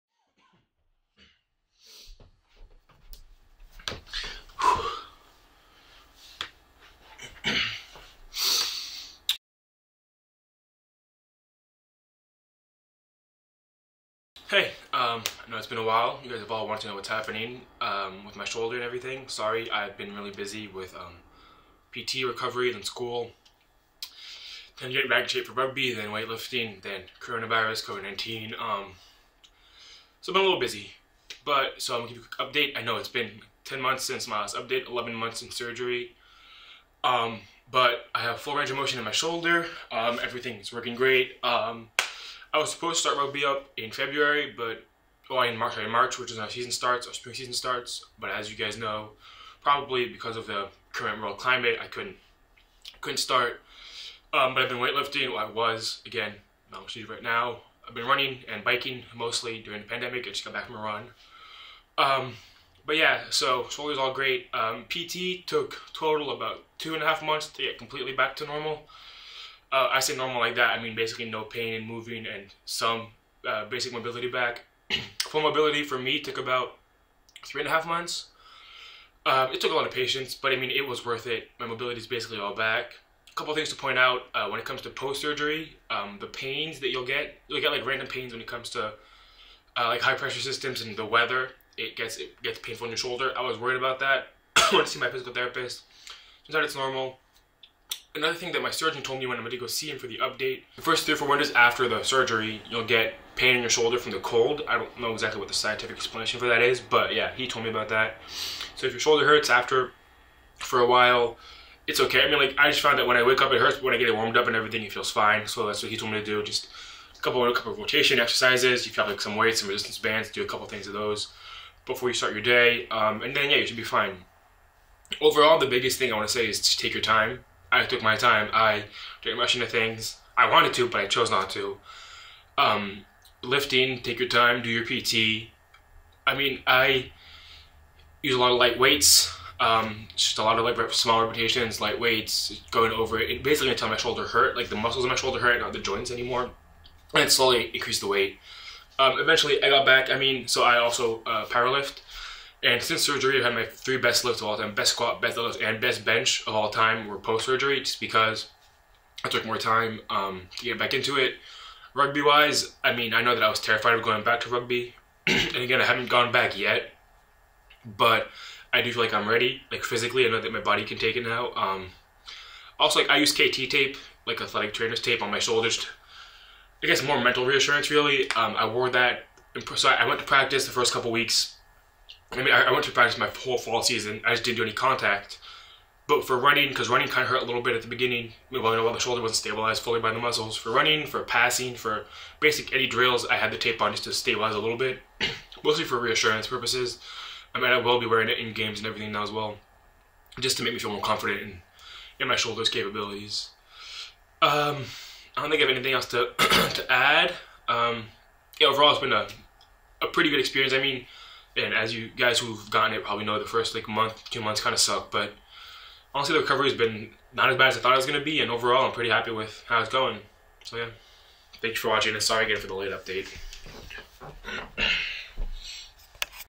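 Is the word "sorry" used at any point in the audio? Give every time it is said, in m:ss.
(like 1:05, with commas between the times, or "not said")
0:19, 0:45, 3:42.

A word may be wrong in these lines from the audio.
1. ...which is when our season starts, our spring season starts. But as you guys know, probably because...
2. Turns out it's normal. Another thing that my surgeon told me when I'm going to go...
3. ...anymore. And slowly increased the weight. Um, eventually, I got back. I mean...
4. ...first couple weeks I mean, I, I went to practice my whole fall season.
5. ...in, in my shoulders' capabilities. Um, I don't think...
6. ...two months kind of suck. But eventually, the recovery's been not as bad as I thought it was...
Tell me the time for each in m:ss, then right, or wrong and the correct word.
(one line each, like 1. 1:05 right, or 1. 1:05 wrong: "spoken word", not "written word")
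1. 0:46 right
2. 1:36 right
3. 2:26 right
4. 3:00 right
5. 3:21 right
6. 3:34 wrong: "honestly", not "eventually".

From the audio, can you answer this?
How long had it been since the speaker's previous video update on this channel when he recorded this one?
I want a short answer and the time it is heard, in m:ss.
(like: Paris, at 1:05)
10 months, at 0:33.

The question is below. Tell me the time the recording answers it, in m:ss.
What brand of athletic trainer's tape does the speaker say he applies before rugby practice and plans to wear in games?
2:53.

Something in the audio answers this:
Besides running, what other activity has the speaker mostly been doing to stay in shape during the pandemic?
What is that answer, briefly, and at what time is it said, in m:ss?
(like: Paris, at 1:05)
biking, at 0:58.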